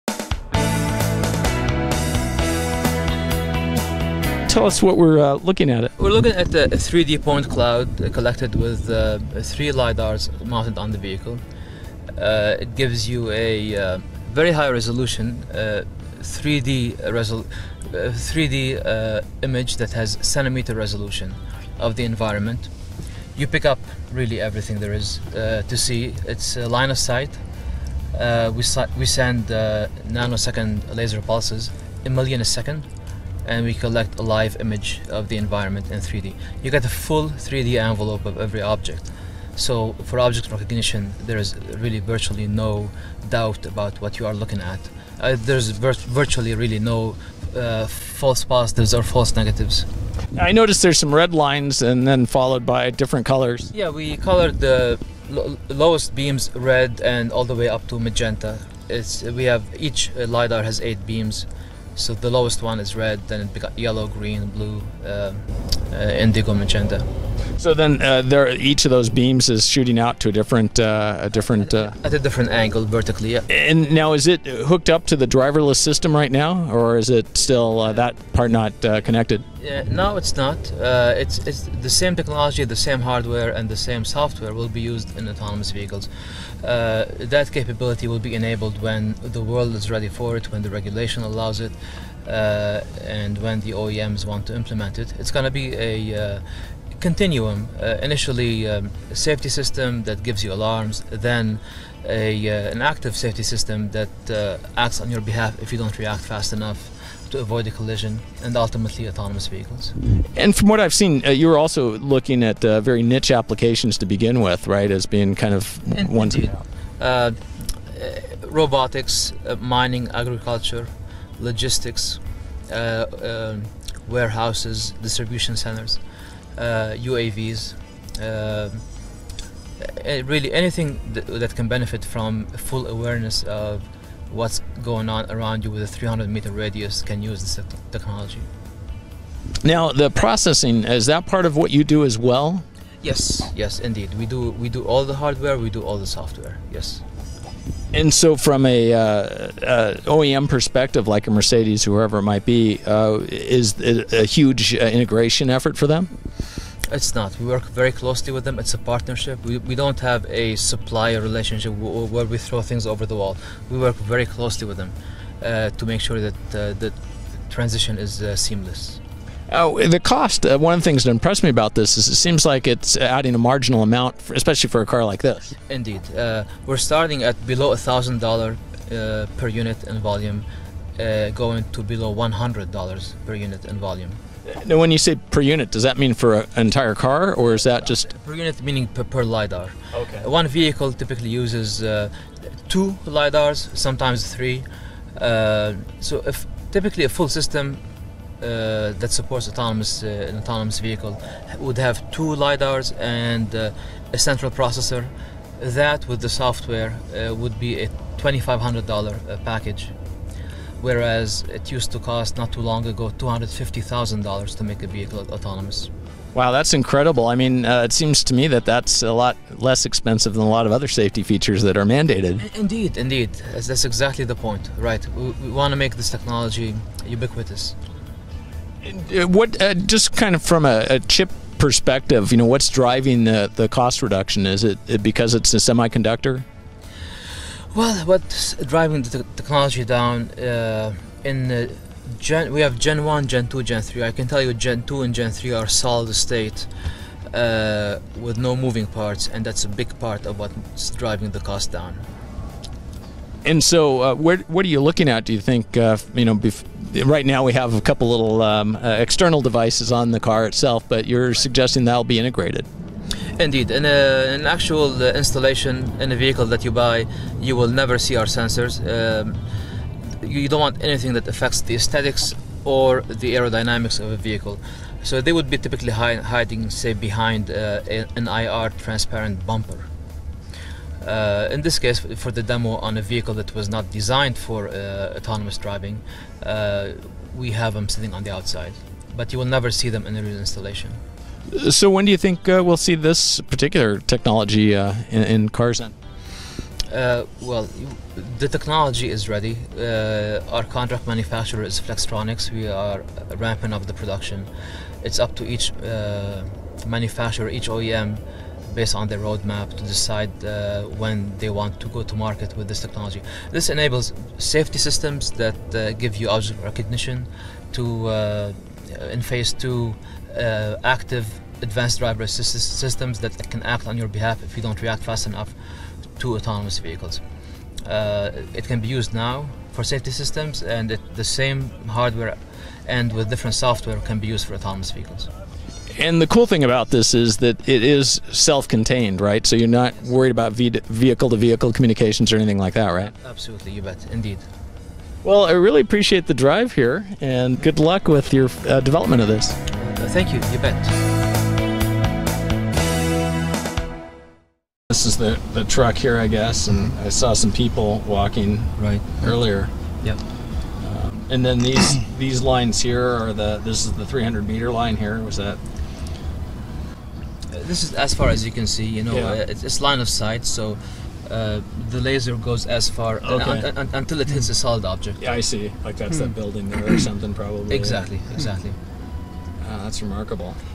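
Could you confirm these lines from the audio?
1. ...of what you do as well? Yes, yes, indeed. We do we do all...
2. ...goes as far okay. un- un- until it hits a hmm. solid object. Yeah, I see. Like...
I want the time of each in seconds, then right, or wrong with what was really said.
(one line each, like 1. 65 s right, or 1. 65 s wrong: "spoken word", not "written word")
1. 141 s right
2. 372 s right.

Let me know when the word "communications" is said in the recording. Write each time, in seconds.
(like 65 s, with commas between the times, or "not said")
341 s.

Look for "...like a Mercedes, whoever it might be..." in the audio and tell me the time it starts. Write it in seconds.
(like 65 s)
151 s.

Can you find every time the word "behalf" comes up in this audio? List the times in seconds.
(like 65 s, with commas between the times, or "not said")
105 s, 324 s.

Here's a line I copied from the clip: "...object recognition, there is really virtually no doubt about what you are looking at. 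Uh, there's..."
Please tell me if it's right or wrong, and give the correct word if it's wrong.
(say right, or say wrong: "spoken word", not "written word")
right.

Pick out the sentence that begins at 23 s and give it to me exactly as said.
You pick up really everything there is to see.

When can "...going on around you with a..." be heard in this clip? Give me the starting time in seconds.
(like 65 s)
134 s.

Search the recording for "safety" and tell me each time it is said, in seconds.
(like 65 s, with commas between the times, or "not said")
99 s, 103 s, 220 s, 314 s, 329 s.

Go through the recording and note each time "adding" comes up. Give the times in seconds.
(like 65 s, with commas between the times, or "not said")
172 s.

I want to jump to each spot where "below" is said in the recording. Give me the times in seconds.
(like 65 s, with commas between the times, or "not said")
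177 s, 181 s.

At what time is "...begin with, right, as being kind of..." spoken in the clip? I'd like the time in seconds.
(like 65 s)
114 s.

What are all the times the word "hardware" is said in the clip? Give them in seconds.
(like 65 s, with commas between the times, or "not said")
83 s, 145 s, 331 s.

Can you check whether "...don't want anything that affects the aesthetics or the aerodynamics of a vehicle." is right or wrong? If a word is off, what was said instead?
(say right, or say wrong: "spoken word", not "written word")
right.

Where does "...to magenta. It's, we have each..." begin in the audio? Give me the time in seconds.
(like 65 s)
57 s.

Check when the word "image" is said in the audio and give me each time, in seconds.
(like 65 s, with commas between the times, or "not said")
19 s, 34 s.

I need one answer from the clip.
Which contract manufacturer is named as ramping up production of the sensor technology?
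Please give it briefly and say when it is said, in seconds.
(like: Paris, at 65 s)
Flextronics, at 301 s.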